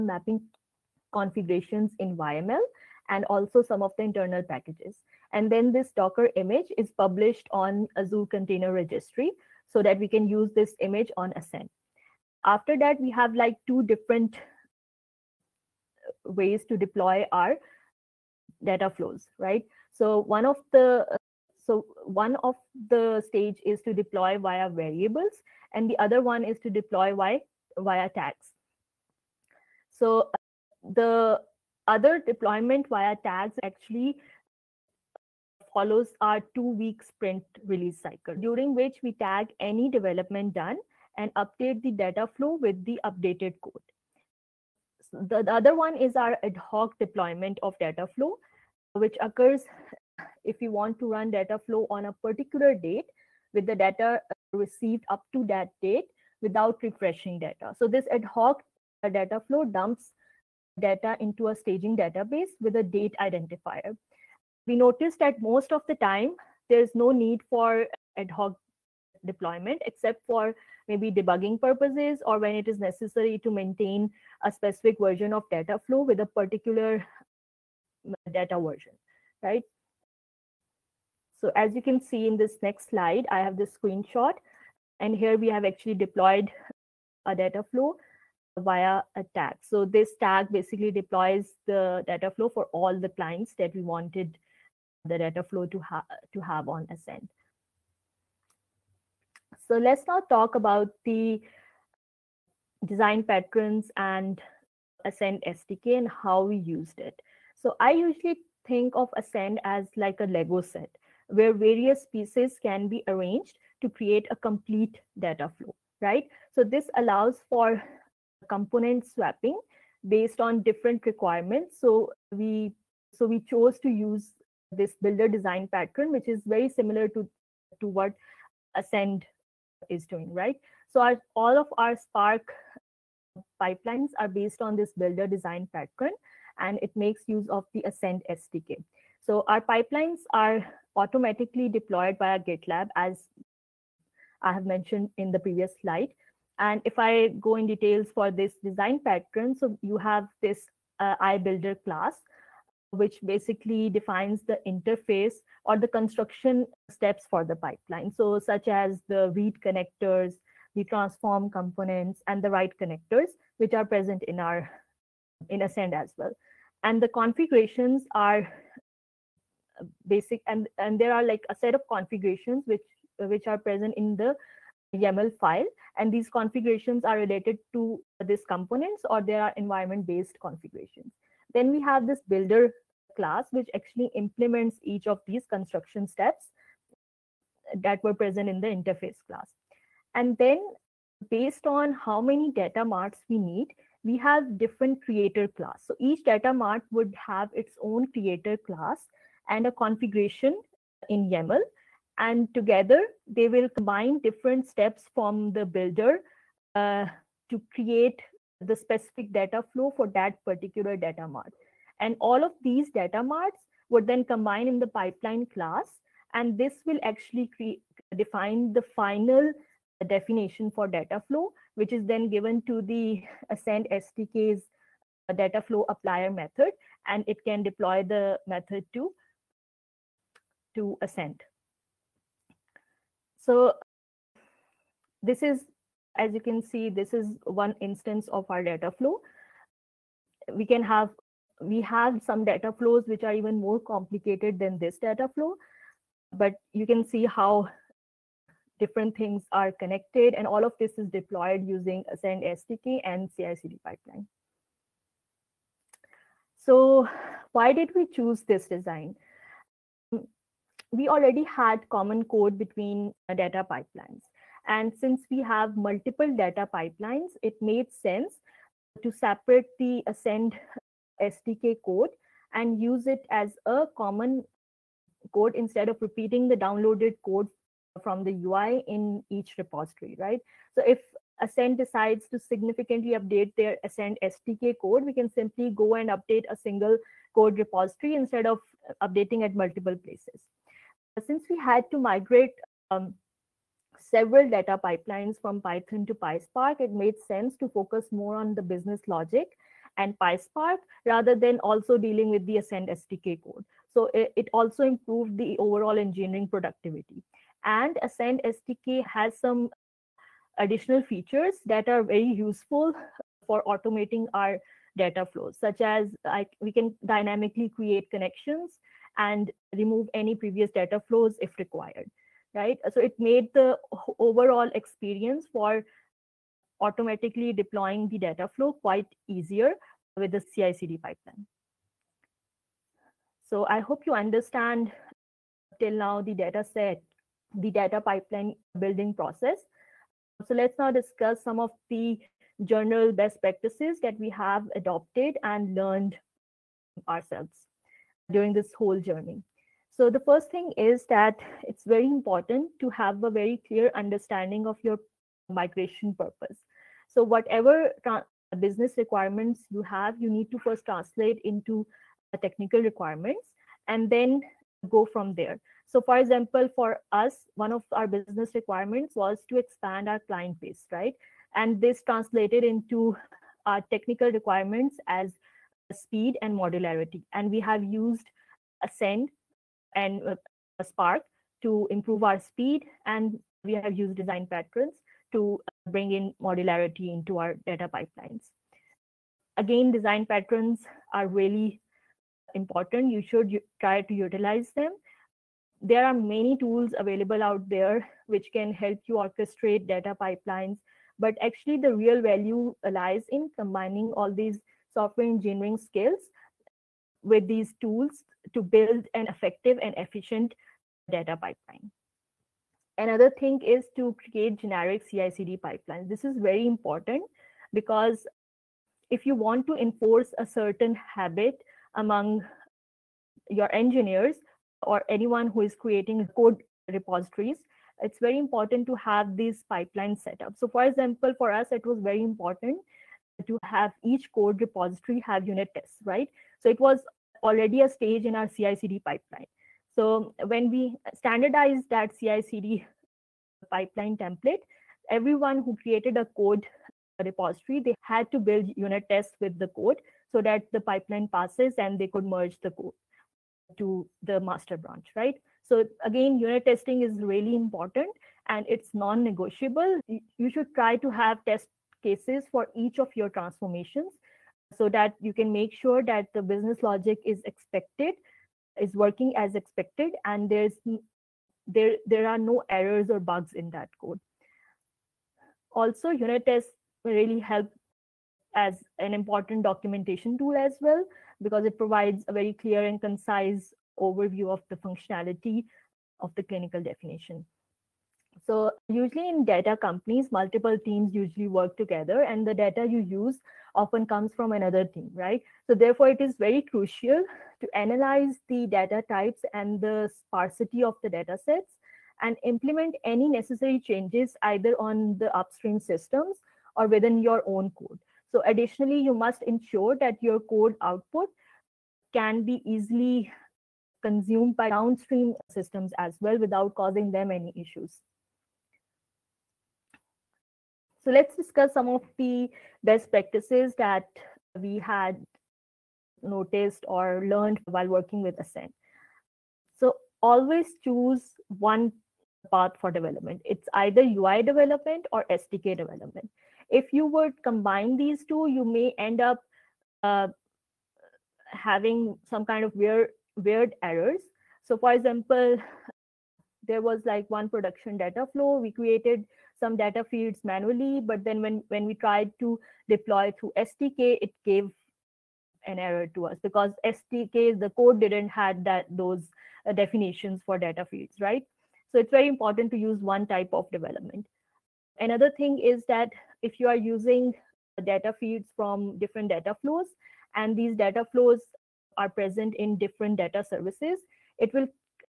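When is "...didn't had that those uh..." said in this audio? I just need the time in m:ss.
9:17.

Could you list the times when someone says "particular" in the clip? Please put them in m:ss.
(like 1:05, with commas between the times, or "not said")
0:52, 1:16, 3:30.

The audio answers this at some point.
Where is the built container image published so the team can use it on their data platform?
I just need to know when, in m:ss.
0:07.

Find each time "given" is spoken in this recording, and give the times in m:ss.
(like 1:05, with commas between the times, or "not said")
3:42.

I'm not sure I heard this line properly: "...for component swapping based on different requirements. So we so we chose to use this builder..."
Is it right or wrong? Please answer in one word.
right.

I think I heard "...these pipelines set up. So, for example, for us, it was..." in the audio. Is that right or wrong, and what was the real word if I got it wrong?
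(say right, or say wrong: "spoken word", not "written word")
right.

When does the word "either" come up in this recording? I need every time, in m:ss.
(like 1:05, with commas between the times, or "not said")
8:24, 8:53.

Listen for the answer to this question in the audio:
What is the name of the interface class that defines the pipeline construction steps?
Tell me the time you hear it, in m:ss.
2:31.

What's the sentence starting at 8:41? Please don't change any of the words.
So let's discuss some of the best practices that we had noticed or learned while working with Ascend.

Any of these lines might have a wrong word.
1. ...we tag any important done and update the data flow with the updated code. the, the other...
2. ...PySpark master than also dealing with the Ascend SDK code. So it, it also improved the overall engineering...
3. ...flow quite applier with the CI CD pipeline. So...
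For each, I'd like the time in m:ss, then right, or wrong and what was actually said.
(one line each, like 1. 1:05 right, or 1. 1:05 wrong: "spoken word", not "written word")
1. 0:39 wrong: "development", not "important"
2. 5:00 wrong: "rather", not "master"
3. 5:28 wrong: "easier", not "applier".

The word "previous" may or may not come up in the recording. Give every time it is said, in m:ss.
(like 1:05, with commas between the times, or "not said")
2:25, 5:20.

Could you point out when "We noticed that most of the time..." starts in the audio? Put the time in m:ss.
1:04.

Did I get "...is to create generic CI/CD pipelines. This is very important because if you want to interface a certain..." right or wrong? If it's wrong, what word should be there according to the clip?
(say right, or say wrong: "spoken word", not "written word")
wrong: "enforce", not "interface".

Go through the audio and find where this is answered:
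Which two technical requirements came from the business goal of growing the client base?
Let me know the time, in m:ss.
6:15.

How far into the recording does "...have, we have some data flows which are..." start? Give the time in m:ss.
4:00.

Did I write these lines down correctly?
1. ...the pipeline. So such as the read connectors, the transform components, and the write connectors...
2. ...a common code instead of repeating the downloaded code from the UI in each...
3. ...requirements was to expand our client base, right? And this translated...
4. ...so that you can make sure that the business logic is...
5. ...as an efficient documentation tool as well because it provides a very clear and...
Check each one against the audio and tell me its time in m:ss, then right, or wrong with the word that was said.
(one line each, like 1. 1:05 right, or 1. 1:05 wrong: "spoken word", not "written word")
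1. 2:37 right
2. 4:33 right
3. 6:08 right
4. 7:44 right
5. 7:58 wrong: "important", not "efficient".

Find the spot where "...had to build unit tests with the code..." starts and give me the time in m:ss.
7:28.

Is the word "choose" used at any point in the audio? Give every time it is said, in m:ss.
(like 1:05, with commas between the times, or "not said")
4:18, 8:50.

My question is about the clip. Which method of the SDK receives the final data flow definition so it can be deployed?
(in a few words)
data flow applier.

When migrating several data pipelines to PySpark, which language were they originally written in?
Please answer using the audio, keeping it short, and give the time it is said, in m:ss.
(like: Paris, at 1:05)
Python, at 4:55.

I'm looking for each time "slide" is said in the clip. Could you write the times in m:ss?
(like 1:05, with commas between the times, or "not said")
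1:22, 2:25.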